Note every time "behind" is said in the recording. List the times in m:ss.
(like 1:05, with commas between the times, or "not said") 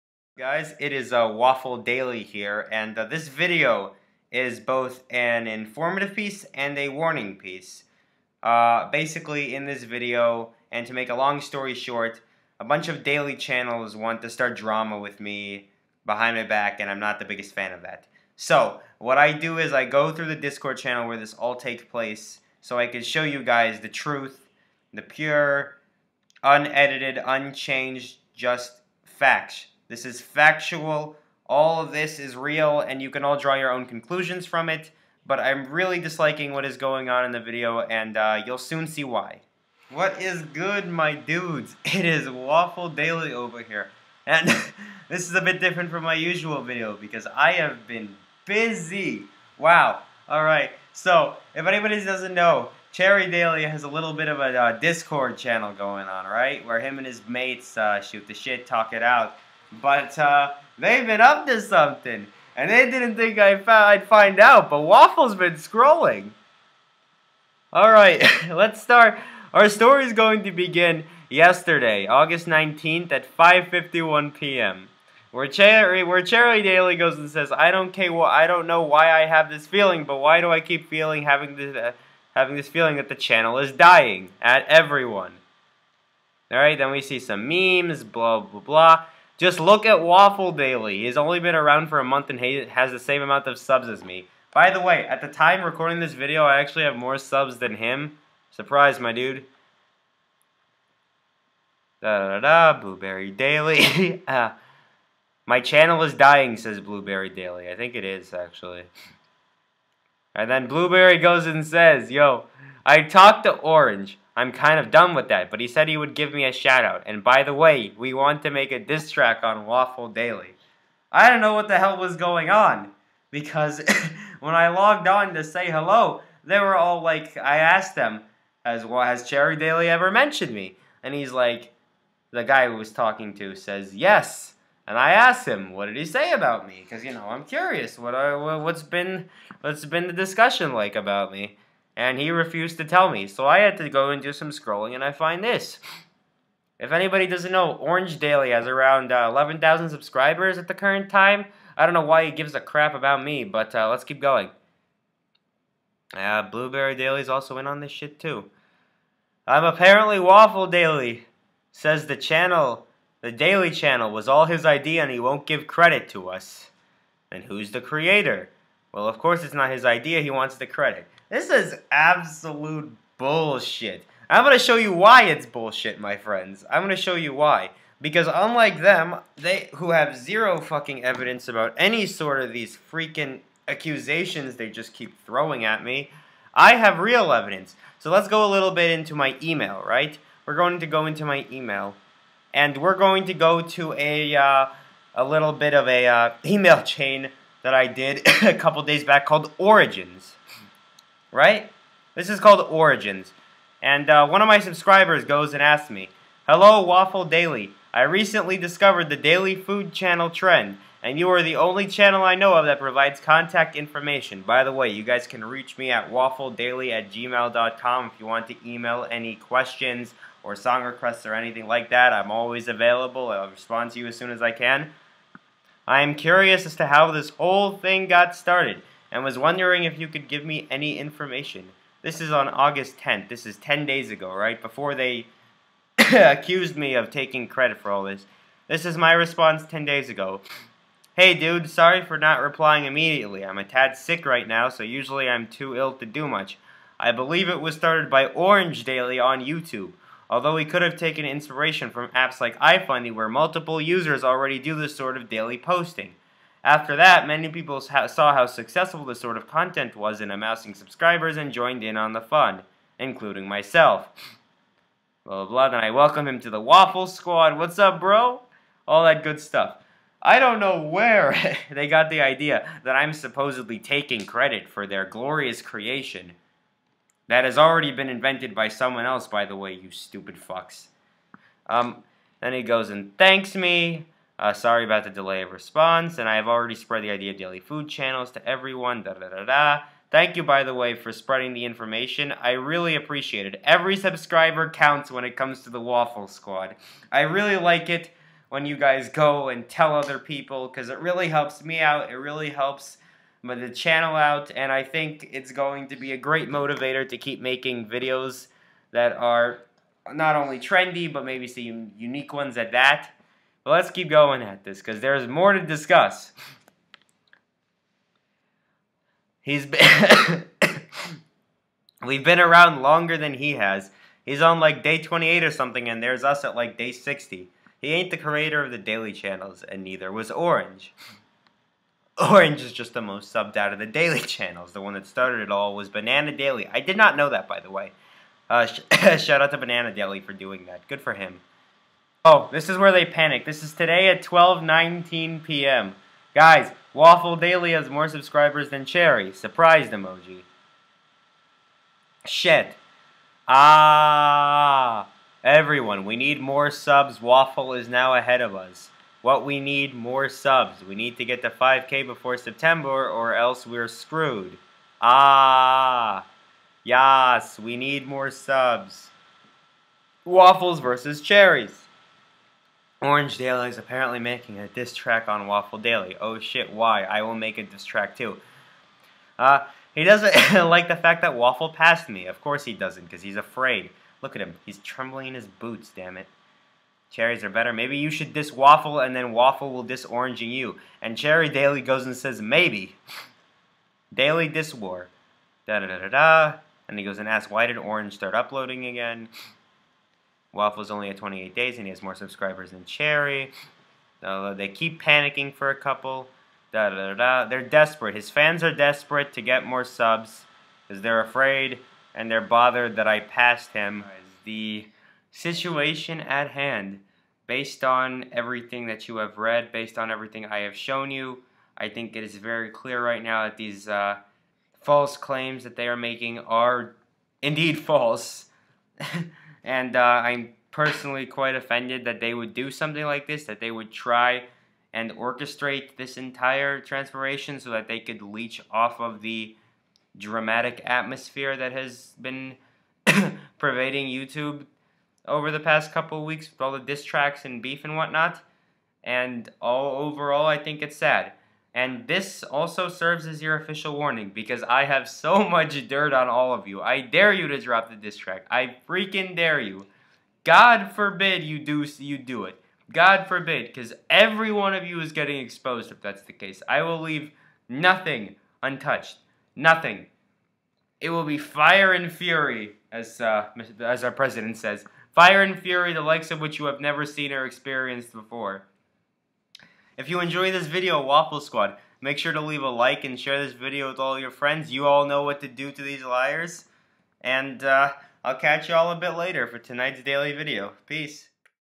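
0:16.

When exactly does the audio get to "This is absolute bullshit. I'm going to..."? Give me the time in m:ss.
2:51.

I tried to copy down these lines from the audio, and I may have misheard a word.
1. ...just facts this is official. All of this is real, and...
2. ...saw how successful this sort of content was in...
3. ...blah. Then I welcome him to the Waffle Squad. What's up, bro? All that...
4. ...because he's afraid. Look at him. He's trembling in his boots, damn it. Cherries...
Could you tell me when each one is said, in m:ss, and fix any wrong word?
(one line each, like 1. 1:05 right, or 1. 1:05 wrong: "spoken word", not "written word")
1. 0:28 wrong: "factual", not "official"
2. 4:17 right
3. 4:25 right
4. 6:23 right.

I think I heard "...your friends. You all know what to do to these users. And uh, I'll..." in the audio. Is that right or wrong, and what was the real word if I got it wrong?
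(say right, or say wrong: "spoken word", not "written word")
wrong: "liars", not "users".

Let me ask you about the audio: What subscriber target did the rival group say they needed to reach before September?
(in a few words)
5K.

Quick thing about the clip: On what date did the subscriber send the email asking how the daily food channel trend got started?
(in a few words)
August 10th.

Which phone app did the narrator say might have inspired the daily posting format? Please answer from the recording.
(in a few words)
iFunny.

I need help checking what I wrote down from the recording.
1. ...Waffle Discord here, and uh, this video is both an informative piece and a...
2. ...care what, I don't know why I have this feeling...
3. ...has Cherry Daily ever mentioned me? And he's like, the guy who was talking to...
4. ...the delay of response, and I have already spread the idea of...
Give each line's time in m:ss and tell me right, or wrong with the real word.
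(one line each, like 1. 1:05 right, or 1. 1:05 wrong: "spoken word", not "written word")
1. 0:01 wrong: "Daily", not "Discord"
2. 1:17 right
3. 2:09 right
4. 4:45 right.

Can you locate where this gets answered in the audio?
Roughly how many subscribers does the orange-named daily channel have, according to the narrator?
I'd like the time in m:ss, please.
2:29.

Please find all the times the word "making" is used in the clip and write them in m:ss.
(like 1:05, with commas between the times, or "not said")
5:07, 6:14, 7:05.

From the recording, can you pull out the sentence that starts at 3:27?
I recently discovered the daily food channel trend, and you are the only channel I know of that provides contact information.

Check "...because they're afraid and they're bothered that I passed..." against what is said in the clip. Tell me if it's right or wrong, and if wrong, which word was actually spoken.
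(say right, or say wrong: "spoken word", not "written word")
right.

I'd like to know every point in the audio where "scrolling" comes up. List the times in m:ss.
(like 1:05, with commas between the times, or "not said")
1:05, 2:24.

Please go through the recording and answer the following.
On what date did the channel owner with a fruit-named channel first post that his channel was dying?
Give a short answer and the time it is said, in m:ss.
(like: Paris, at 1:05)
August 19th, at 1:12.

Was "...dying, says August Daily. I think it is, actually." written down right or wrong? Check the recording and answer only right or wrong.
wrong.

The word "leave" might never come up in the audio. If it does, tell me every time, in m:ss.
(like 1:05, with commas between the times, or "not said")
7:46, 8:02.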